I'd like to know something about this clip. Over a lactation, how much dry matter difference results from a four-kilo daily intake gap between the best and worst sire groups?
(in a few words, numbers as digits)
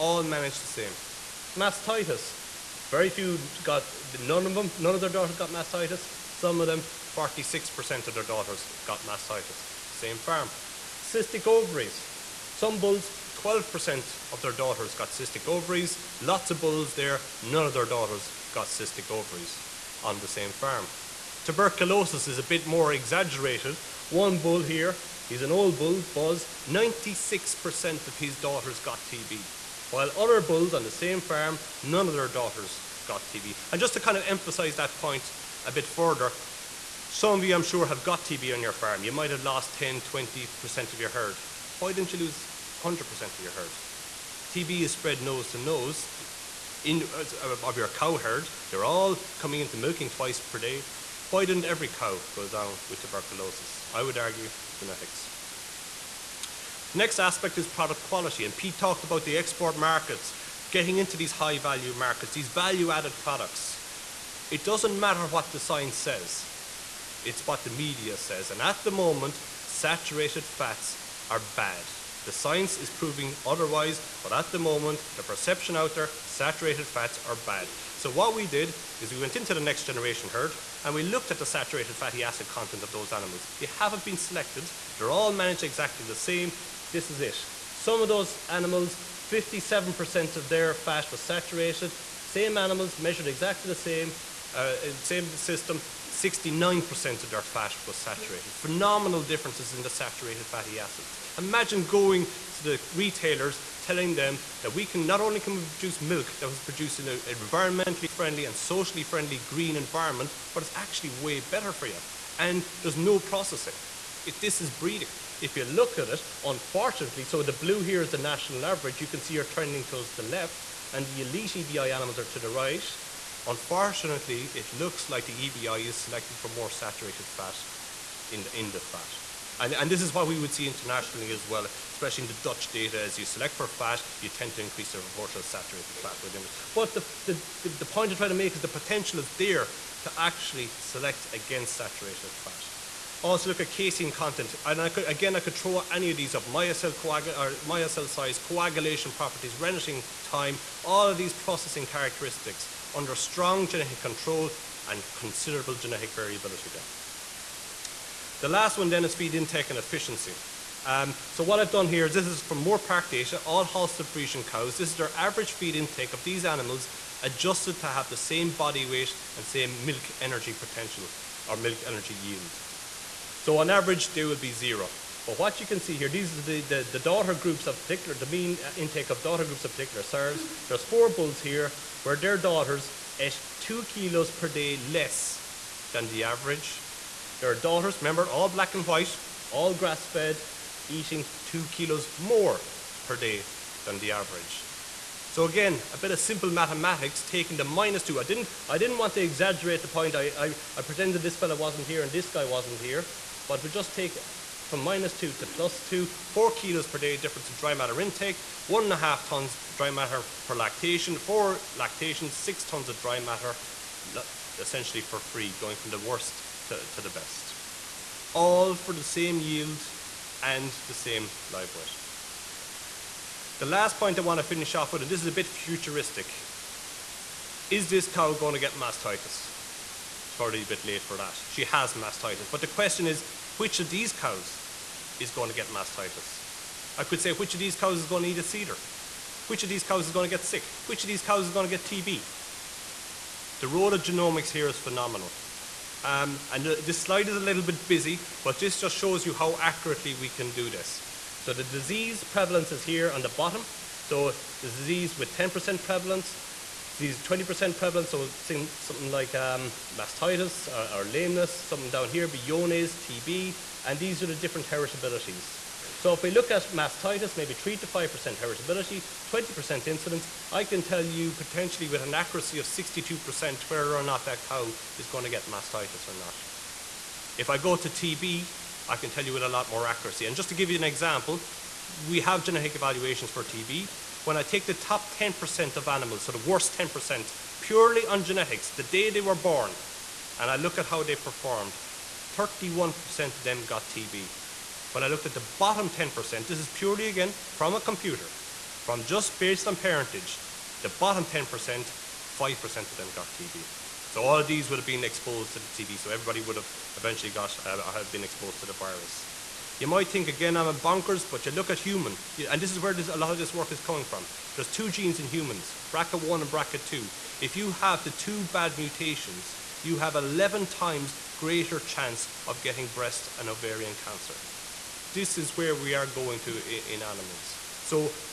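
1.5 tons.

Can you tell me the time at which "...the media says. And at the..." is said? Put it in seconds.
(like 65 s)
67 s.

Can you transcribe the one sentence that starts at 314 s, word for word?
There's two genes in humans, BRCA1 and BRCA2.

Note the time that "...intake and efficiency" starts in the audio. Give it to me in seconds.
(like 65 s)
159 s.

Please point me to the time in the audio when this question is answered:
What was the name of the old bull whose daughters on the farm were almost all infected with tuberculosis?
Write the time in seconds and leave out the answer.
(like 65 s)
26 s.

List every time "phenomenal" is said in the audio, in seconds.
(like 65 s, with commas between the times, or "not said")
98 s, 244 s.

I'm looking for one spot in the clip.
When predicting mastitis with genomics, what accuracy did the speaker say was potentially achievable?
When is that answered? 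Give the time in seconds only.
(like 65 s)
272 s.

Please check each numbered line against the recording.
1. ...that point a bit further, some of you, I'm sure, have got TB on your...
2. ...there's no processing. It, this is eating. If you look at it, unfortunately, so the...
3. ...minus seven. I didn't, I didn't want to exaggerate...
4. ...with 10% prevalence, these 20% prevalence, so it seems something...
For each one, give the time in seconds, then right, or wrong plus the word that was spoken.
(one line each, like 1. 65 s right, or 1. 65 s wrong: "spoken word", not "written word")
1. 34 s right
2. 112 s wrong: "breeding", not "eating"
3. 197 s wrong: "two", not "seven"
4. 255 s right.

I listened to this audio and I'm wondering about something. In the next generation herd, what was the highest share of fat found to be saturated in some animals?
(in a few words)
69%.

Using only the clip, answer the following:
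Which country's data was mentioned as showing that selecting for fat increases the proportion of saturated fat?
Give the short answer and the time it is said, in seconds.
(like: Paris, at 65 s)
Dutch, at 132 s.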